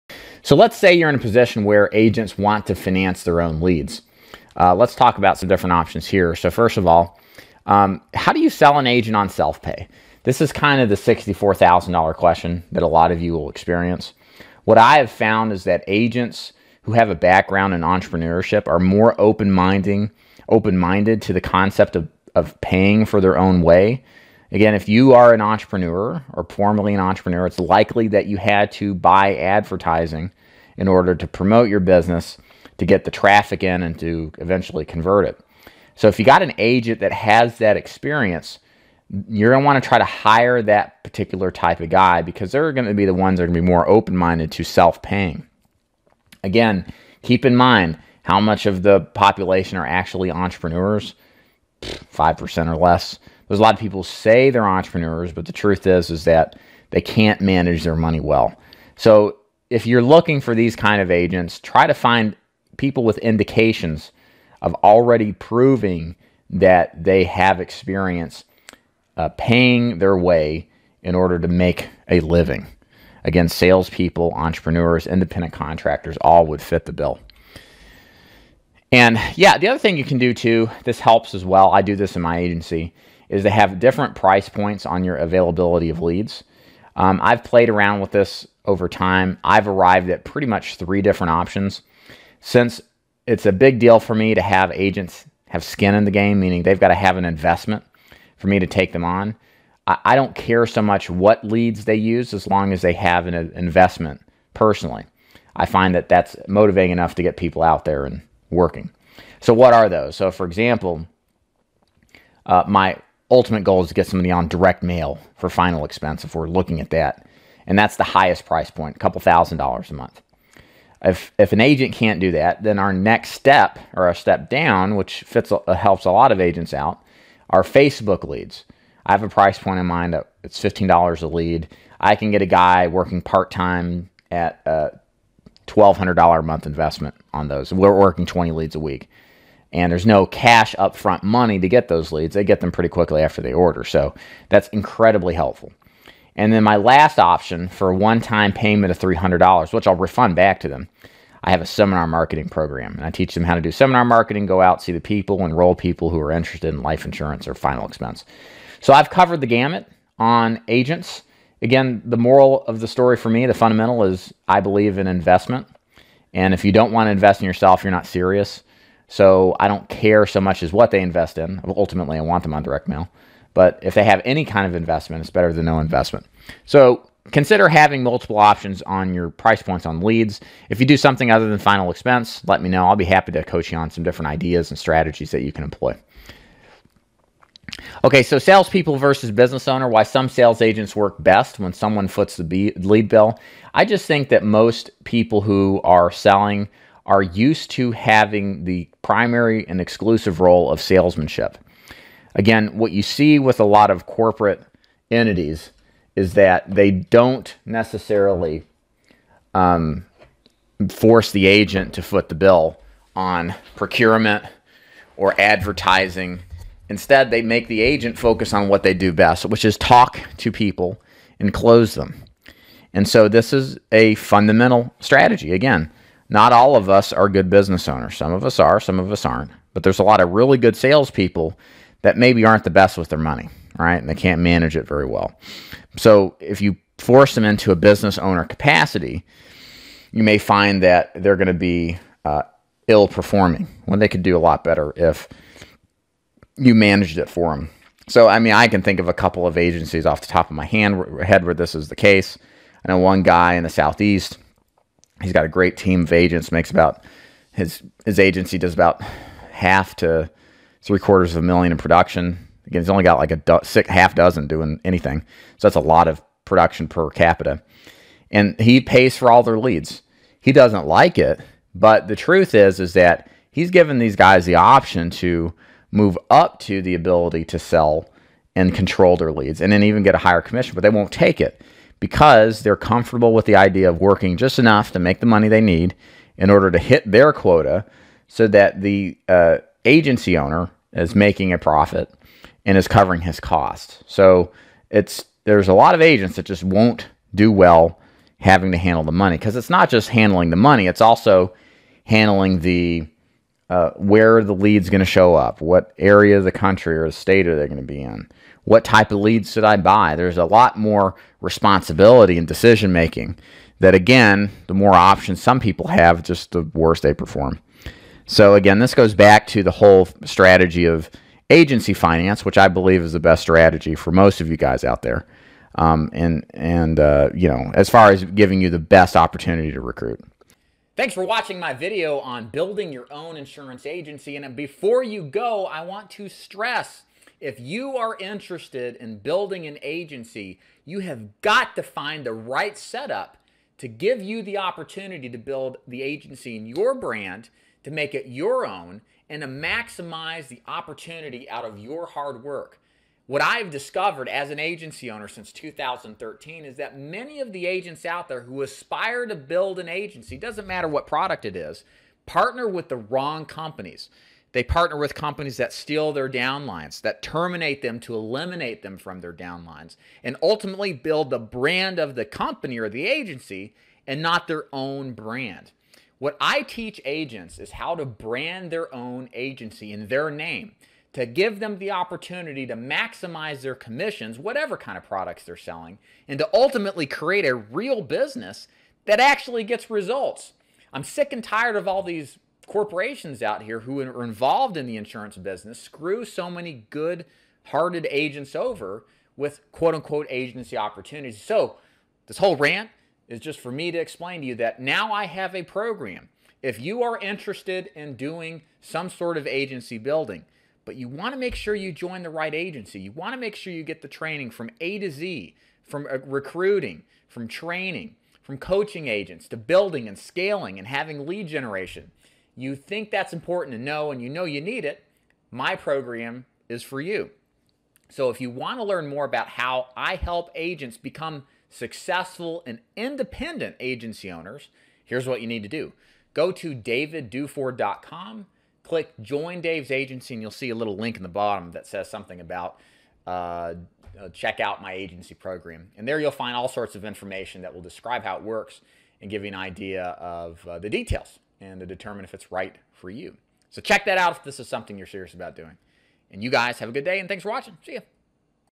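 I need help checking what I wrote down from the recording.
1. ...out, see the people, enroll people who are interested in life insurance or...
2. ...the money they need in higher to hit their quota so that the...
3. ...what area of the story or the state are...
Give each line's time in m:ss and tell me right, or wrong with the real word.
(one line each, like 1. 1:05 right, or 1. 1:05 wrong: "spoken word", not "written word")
1. 2:34 right
2. 4:45 wrong: "order", not "higher"
3. 5:05 wrong: "country", not "story".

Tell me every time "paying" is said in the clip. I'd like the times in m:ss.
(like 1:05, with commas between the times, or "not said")
0:22, 0:45, 1:09.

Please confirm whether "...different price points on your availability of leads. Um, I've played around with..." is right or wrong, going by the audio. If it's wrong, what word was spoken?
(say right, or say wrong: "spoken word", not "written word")
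right.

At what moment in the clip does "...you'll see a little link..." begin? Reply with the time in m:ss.
7:20.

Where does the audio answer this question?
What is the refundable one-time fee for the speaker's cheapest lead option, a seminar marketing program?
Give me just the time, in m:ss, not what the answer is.
2:28.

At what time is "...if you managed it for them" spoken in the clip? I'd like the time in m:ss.
4:04.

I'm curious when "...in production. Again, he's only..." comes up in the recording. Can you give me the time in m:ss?
4:21.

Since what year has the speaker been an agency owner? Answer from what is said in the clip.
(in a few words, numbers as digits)
2013.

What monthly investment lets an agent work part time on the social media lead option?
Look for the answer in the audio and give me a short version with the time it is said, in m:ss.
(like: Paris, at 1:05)
$1,200, at 2:15.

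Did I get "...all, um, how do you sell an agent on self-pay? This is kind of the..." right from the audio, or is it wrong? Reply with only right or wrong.
right.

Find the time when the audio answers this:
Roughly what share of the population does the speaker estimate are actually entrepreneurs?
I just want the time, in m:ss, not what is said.
0:51.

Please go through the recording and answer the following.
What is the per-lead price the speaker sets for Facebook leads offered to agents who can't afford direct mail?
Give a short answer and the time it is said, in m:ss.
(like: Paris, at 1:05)
$15, at 2:10.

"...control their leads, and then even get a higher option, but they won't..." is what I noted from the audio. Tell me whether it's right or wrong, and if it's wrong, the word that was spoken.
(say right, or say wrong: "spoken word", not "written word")
wrong: "commission", not "option".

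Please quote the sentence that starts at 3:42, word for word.
And so, this is a fundamental strategy.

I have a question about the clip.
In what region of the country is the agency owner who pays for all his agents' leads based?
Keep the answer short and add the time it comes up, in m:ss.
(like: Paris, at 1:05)
Southeast, at 4:13.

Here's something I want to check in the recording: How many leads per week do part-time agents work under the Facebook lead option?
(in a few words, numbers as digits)
20.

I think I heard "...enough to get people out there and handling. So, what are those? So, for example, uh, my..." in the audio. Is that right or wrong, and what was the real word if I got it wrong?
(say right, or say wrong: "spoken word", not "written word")
wrong: "working", not "handling".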